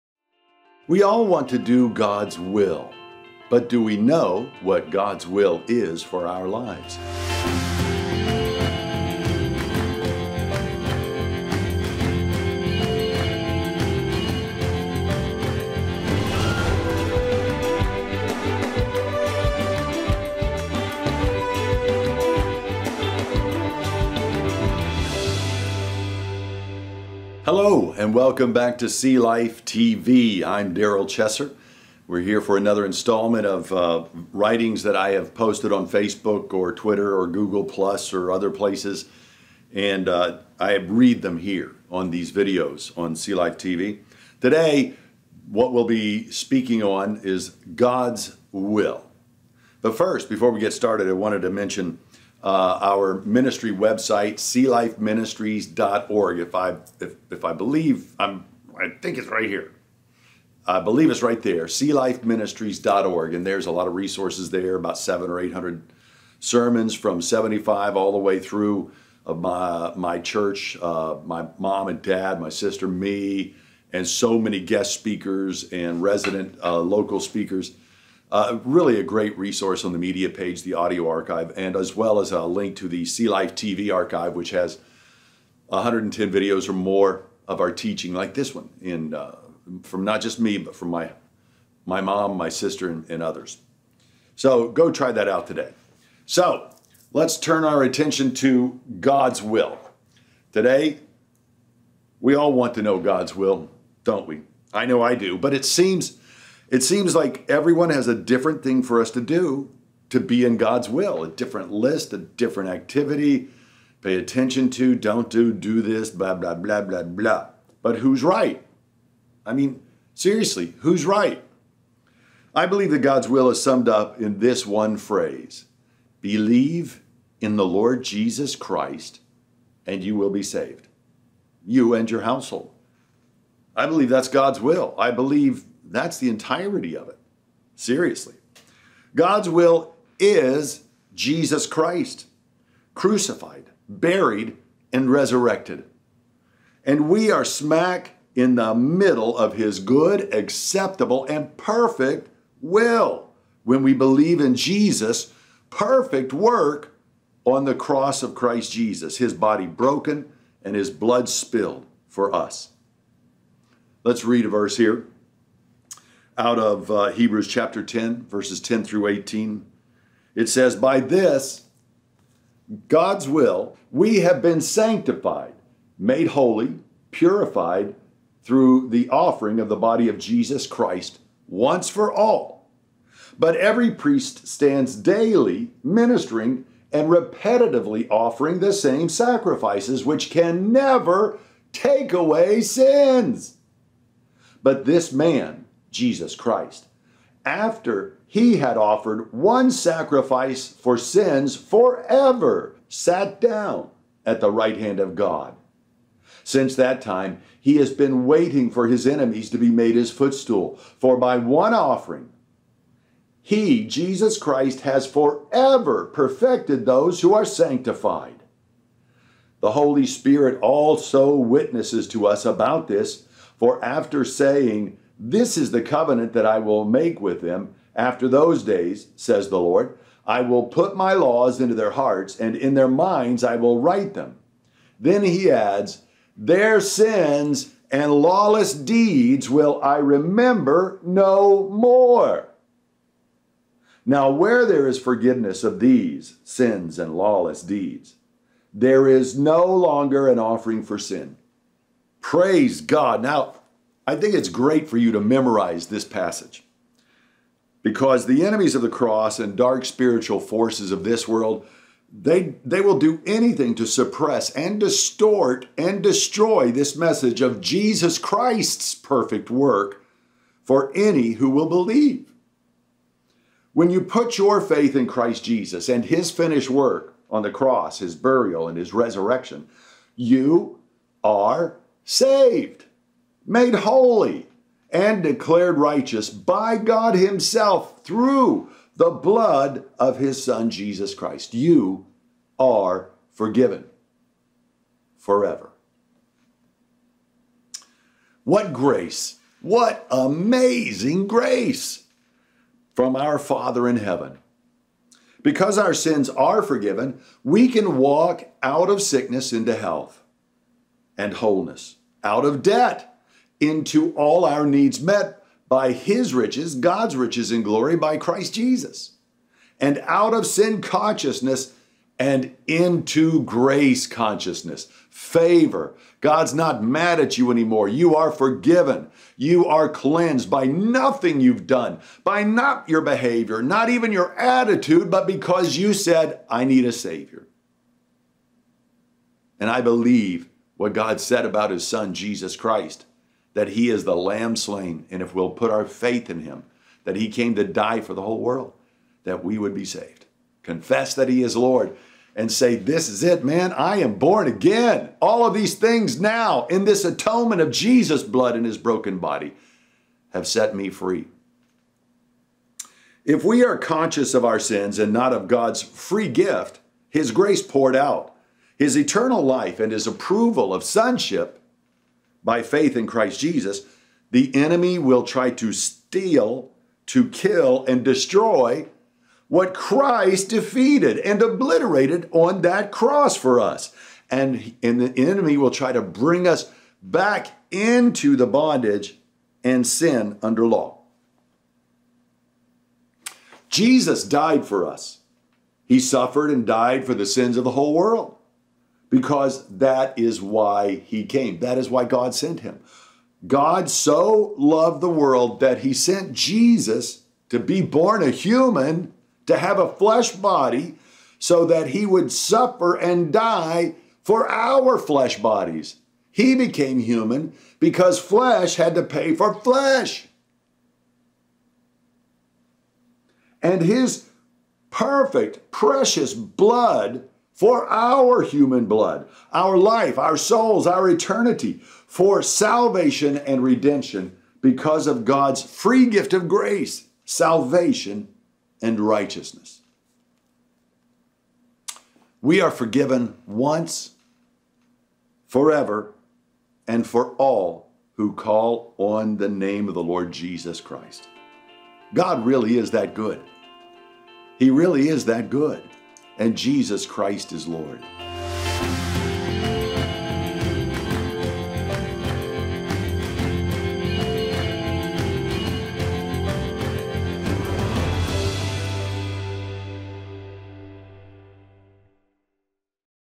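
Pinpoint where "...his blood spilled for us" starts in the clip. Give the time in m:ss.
2:40.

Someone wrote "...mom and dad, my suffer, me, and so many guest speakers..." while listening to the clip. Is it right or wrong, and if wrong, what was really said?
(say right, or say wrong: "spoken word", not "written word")
wrong: "sister", not "suffer".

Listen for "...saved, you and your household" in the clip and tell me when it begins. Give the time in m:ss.
2:10.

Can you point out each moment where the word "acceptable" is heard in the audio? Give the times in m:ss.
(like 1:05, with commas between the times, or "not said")
2:30.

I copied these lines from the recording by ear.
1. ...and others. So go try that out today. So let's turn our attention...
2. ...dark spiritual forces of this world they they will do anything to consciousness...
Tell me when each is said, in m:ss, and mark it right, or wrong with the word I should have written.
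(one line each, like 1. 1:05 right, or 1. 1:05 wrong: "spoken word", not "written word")
1. 1:33 right
2. 4:19 wrong: "suppress", not "consciousness".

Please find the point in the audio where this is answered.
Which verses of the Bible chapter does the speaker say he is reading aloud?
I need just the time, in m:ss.
2:48.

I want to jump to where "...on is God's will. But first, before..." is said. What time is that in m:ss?
0:46.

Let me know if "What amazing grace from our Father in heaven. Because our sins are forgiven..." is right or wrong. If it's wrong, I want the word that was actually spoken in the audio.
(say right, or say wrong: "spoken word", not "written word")
right.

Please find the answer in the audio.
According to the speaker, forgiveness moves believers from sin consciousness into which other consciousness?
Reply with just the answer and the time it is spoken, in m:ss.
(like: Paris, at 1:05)
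Grace consciousness, at 5:23.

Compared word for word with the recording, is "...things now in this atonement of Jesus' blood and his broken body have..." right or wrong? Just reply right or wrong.
right.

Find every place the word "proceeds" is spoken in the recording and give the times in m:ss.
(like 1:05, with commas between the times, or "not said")
not said.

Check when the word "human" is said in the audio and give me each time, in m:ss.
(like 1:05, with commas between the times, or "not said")
6:48, 6:56, 7:08.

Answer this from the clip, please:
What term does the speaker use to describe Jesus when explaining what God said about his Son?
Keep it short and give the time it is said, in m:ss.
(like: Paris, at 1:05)
The lamb slain, at 5:44.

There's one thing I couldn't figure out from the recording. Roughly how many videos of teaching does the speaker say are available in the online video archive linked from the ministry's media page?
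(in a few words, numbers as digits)
110.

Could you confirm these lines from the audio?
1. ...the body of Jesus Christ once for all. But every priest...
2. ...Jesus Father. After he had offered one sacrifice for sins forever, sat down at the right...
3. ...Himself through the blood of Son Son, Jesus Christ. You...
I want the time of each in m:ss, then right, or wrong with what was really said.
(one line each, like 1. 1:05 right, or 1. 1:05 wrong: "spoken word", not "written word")
1. 2:59 right
2. 3:15 wrong: "Christ", not "Father"
3. 4:47 wrong: "His", not "Son".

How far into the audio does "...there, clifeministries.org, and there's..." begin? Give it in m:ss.
1:01.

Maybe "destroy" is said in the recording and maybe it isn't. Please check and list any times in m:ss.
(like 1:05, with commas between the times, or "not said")
4:26, 6:18.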